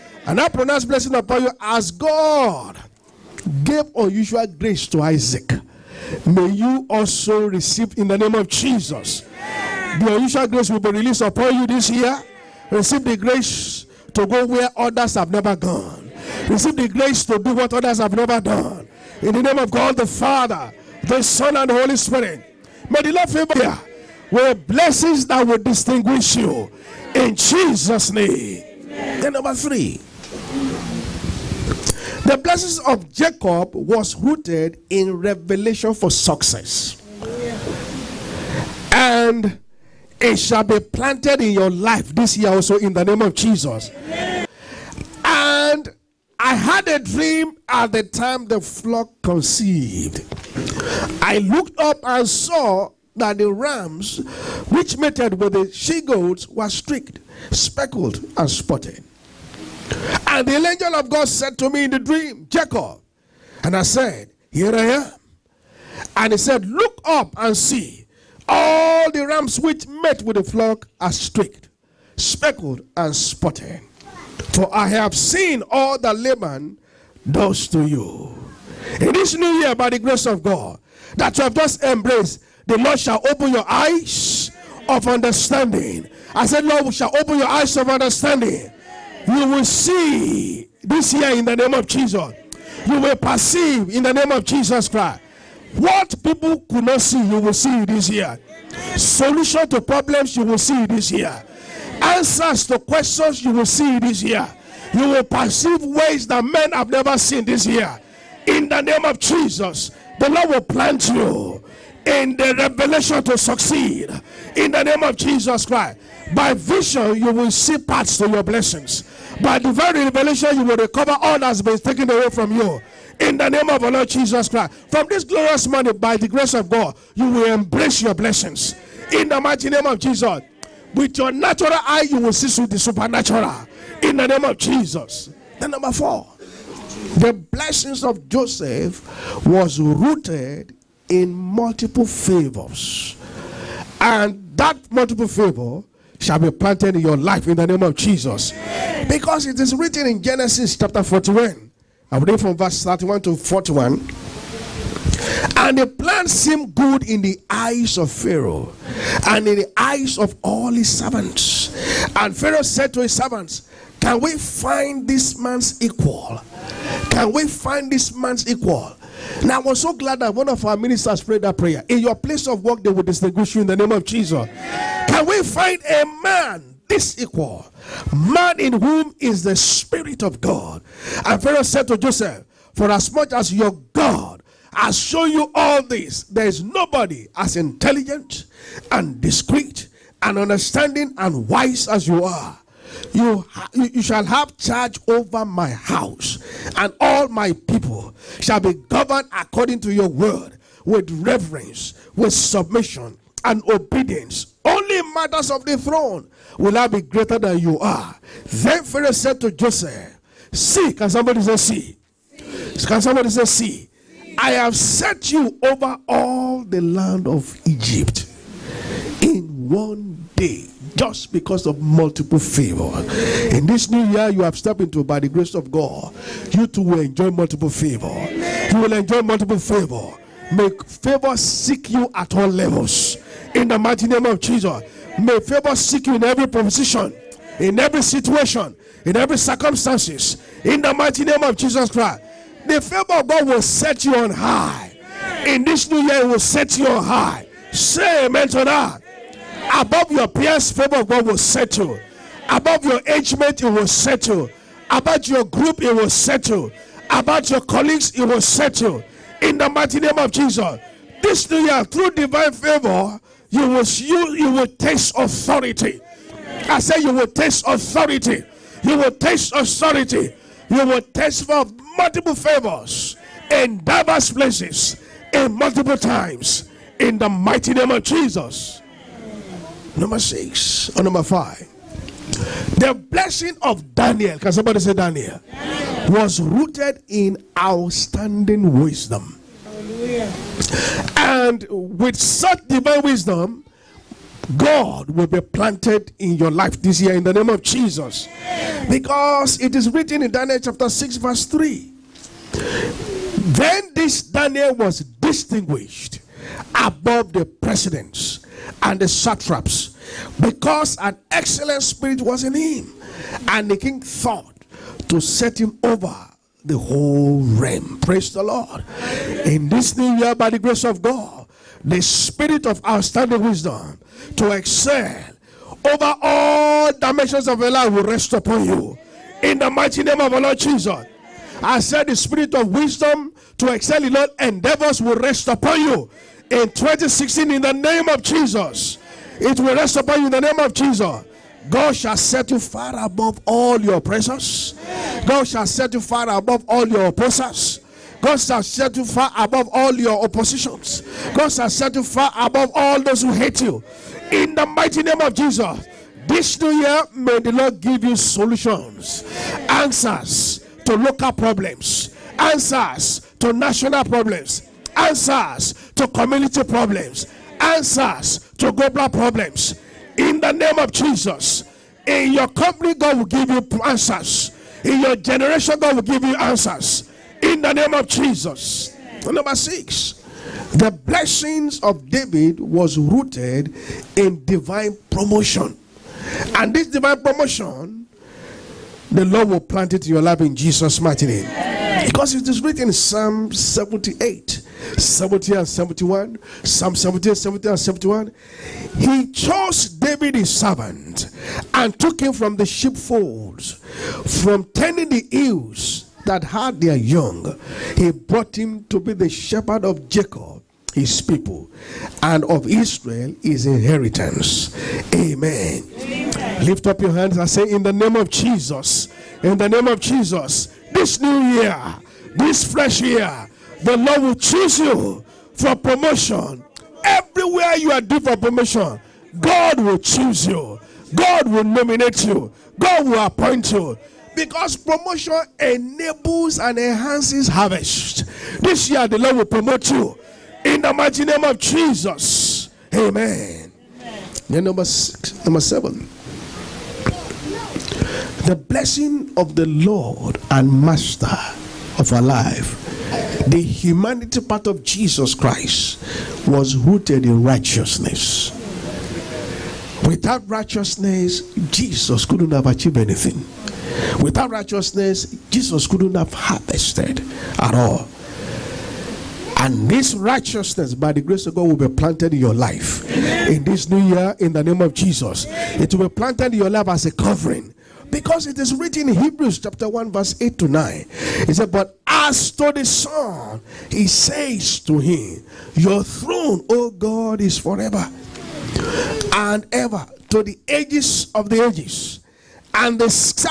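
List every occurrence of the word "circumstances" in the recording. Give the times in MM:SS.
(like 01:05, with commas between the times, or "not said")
03:59.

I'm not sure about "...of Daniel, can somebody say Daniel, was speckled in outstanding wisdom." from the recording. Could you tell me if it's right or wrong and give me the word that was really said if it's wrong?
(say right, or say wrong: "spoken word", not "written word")
wrong: "rooted", not "speckled".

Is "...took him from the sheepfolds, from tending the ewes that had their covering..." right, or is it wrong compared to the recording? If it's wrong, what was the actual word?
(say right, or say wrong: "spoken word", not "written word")
wrong: "young", not "covering".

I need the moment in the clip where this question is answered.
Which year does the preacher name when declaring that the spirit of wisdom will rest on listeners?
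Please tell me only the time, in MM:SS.
05:36.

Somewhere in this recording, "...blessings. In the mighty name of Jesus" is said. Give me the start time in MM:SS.
02:08.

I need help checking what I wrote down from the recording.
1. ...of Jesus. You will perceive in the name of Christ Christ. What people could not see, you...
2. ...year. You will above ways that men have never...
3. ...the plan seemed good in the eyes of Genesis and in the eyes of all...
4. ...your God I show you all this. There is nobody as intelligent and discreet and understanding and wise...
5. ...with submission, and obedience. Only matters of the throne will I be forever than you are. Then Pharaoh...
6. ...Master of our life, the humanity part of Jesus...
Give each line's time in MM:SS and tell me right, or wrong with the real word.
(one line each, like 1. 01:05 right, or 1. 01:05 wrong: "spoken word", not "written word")
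1. 01:31 wrong: "Jesus", not "Christ"
2. 01:44 wrong: "perceive", not "above"
3. 02:35 wrong: "Pharaoh", not "Genesis"
4. 03:03 right
5. 03:22 wrong: "greater", not "forever"
6. 07:30 right.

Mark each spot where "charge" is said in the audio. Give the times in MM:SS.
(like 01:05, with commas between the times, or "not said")
03:14.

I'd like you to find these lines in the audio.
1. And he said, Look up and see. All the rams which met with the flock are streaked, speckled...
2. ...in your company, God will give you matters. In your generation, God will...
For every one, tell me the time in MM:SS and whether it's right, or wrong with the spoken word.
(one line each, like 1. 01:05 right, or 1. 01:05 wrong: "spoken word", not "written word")
1. 01:06 right
2. 06:12 wrong: "answers", not "matters".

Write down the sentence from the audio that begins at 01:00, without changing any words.
And the angel of God said to me in the dream, Jacob.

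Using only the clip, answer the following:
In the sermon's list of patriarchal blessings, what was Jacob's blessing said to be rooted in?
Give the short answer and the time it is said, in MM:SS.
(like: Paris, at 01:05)
Revelation for success, at 00:35.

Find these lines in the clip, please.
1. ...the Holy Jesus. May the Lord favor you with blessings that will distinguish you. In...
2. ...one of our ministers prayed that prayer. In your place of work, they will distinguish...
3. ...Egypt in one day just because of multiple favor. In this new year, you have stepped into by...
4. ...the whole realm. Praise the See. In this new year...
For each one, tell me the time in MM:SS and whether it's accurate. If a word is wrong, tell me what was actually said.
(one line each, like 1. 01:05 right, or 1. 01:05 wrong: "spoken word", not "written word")
1. 00:21 wrong: "Spirit", not "Jesus"
2. 02:50 right
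3. 03:37 right
4. 05:16 wrong: "Lord", not "See".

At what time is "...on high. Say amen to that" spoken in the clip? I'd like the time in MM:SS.
04:06.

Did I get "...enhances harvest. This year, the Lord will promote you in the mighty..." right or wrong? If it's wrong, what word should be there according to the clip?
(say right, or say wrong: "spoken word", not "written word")
right.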